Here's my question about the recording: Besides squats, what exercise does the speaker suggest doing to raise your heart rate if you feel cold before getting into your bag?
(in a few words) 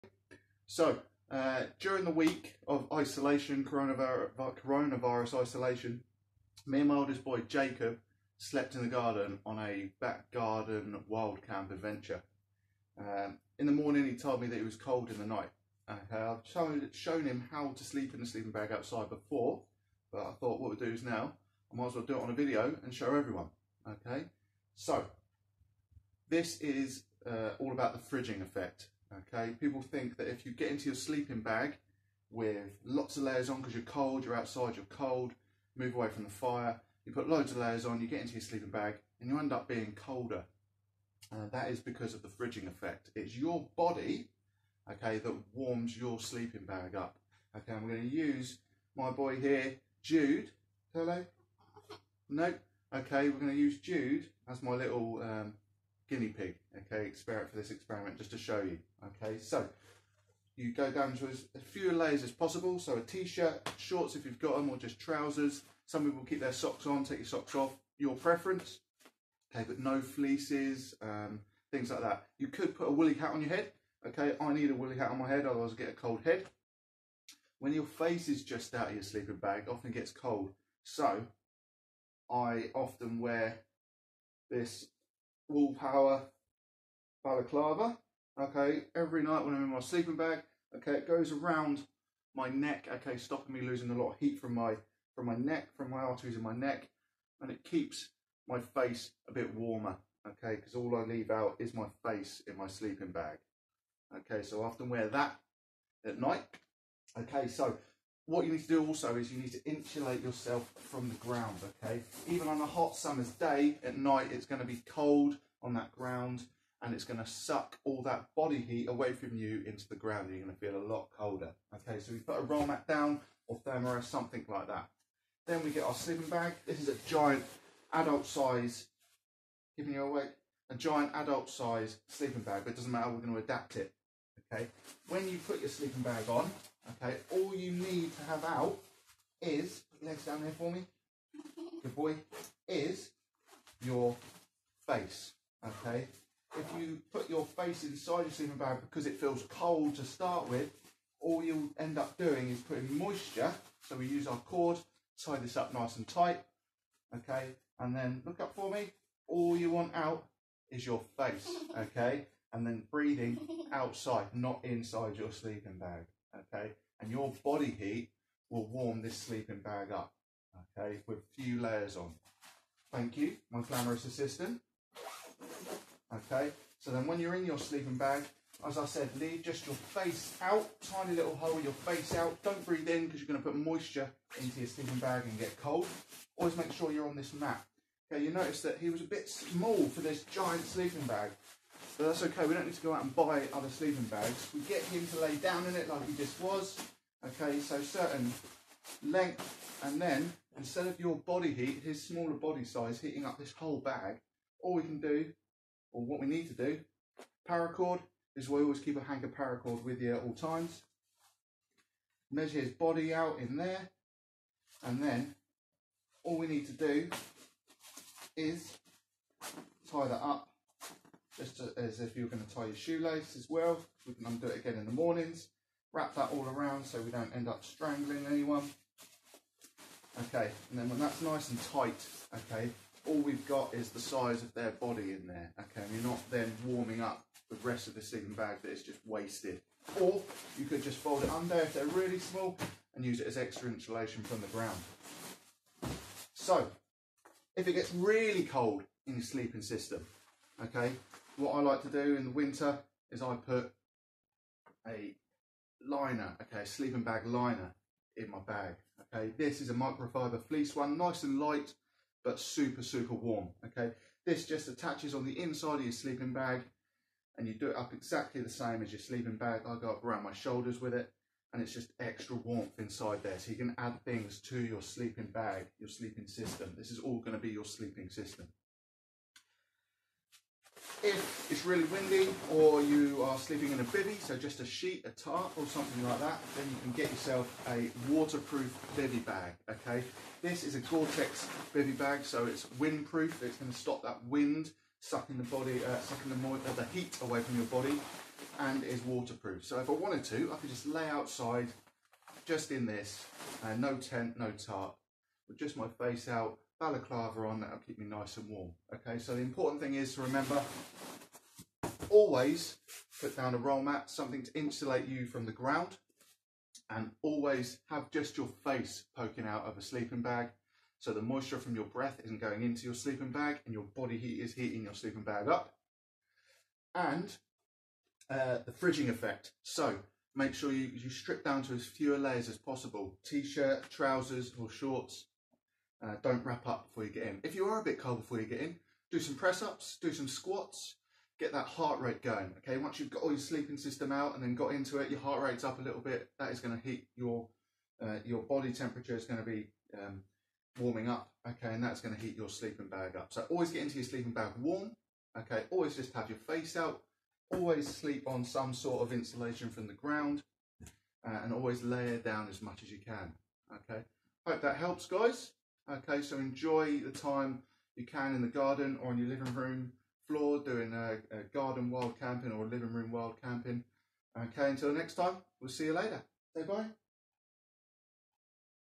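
Press ups.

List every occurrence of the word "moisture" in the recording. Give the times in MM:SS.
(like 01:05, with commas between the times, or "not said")
02:32, 03:03, 05:21.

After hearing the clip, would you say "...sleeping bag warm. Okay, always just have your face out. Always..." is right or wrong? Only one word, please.
right.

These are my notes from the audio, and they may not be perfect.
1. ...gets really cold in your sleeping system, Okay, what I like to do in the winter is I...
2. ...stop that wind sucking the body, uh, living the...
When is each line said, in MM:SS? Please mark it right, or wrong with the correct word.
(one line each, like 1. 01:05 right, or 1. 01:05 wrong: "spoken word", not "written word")
1. 04:07 right
2. 04:53 wrong: "sucking", not "living".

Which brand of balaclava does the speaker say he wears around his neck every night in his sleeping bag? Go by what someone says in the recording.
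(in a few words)
Willpower.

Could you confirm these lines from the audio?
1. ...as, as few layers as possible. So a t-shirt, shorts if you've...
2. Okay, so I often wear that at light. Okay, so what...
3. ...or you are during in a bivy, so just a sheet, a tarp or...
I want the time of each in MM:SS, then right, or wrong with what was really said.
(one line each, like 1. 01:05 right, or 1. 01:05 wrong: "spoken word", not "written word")
1. 01:01 right
2. 01:44 wrong: "night", not "light"
3. 04:42 wrong: "sleeping", not "during".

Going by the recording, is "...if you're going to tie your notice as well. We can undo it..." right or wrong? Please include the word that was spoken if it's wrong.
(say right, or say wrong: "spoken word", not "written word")
wrong: "shoelace", not "notice".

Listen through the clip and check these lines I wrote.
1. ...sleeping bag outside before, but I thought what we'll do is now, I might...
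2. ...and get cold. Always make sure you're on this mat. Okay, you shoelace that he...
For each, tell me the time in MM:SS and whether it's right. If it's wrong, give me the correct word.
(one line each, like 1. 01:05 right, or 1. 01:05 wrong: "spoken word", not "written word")
1. 00:18 right
2. 03:05 wrong: "notice", not "shoelace".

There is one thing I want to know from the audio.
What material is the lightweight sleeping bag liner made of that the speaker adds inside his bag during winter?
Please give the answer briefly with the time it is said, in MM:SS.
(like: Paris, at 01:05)
Microfiber fleece, at 04:19.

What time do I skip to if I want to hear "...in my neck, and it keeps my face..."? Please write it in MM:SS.
01:36.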